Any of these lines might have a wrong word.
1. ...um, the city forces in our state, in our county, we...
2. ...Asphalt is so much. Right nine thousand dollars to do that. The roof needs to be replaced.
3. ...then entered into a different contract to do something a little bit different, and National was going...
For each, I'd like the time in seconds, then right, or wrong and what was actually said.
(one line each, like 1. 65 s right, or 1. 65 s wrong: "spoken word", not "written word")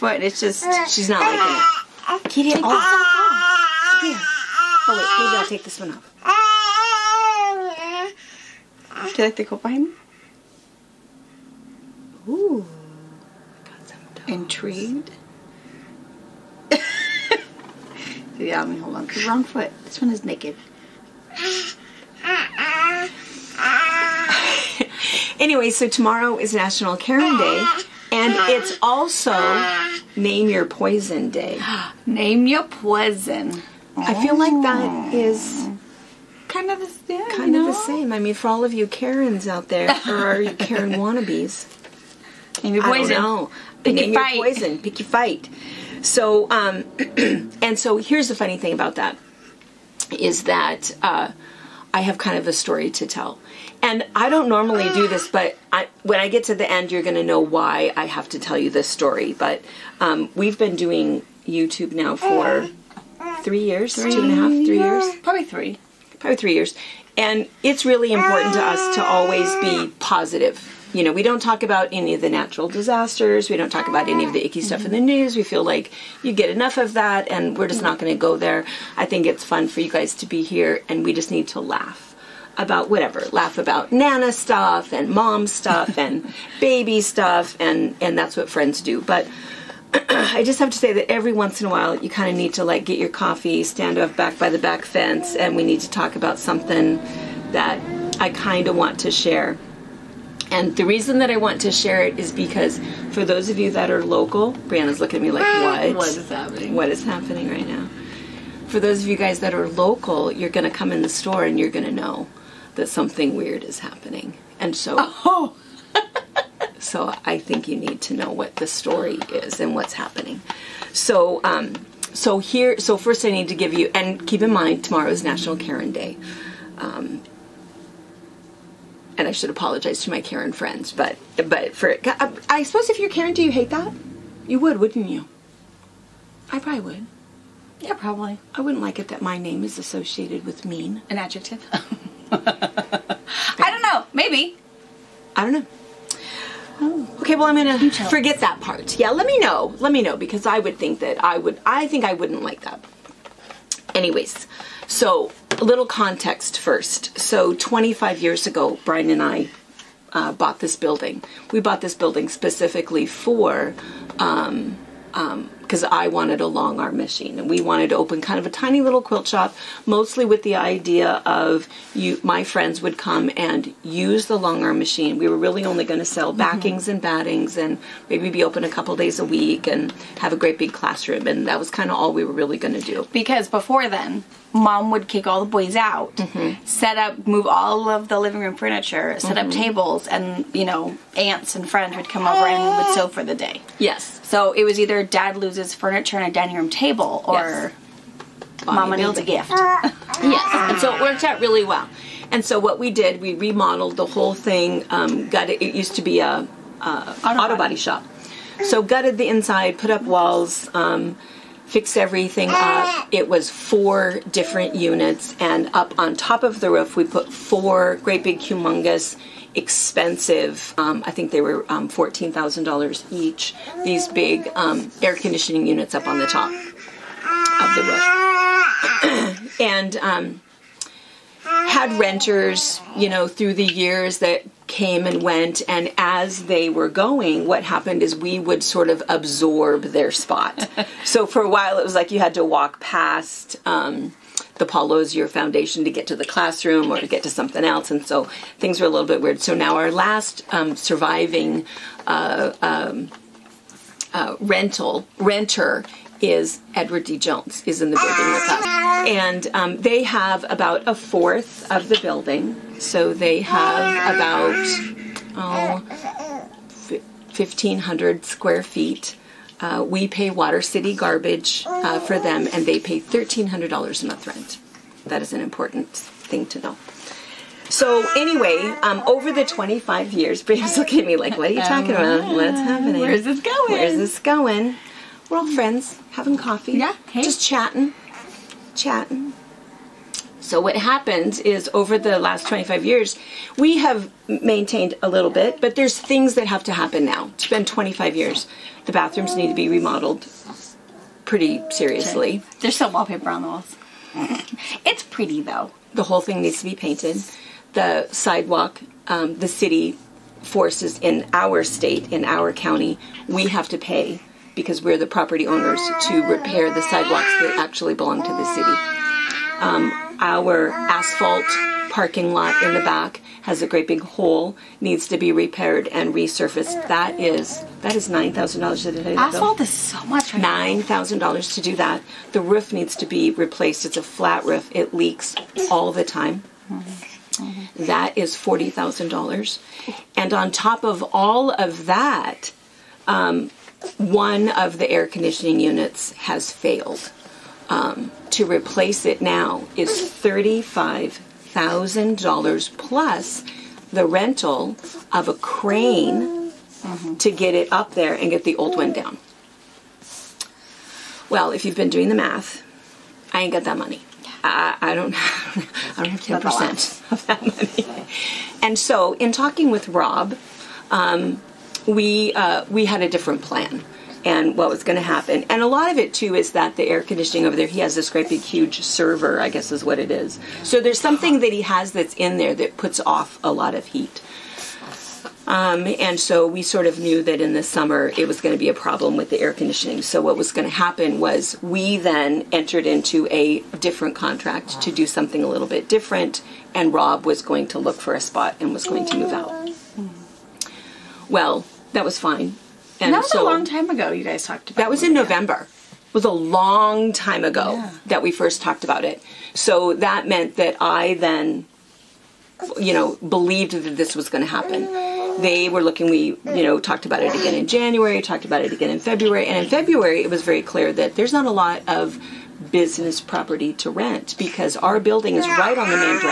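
1. 309 s right
2. 329 s right
3. 391 s wrong: "Rob", not "National".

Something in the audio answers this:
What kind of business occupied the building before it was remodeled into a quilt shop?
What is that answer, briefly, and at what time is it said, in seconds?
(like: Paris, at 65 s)
auto body shop, at 206 s.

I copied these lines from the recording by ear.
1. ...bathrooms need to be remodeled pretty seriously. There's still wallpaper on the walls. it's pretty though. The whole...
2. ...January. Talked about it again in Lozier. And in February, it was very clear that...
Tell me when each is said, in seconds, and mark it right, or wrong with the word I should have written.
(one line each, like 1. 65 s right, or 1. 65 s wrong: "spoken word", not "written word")
1. 298 s right
2. 417 s wrong: "February", not "Lozier".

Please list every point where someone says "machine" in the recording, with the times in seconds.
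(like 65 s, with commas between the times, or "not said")
166 s, 174 s.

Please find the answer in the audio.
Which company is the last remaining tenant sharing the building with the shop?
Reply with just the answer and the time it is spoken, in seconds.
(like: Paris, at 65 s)
Edward D. Jones, at 256 s.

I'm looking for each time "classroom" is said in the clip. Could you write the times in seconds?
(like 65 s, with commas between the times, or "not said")
180 s, 246 s.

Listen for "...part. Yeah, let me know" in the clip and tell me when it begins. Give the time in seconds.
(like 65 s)
148 s.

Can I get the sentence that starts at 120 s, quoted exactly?
So, um, so here, so first I need to give you, and keep in mind, tomorrow is National Karen Day.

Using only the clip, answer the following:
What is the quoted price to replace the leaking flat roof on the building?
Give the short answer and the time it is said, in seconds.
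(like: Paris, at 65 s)
$40,000, at 338 s.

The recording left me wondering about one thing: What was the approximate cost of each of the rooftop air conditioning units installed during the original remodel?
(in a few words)
$14,000.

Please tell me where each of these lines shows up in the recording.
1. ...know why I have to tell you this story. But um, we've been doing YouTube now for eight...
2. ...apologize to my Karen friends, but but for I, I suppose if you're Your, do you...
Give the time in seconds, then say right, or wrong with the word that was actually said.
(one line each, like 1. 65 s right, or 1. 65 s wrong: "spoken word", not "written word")
1. 57 s wrong: "three", not "eight"
2. 129 s wrong: "Karen", not "Your".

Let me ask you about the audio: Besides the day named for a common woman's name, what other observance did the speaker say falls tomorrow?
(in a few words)
Name Your Poison Day.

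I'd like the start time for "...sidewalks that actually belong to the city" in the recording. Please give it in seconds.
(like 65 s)
316 s.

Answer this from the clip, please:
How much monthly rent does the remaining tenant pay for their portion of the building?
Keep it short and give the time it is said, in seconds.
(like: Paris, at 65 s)
$1,300, at 272 s.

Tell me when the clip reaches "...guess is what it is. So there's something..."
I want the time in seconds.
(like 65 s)
379 s.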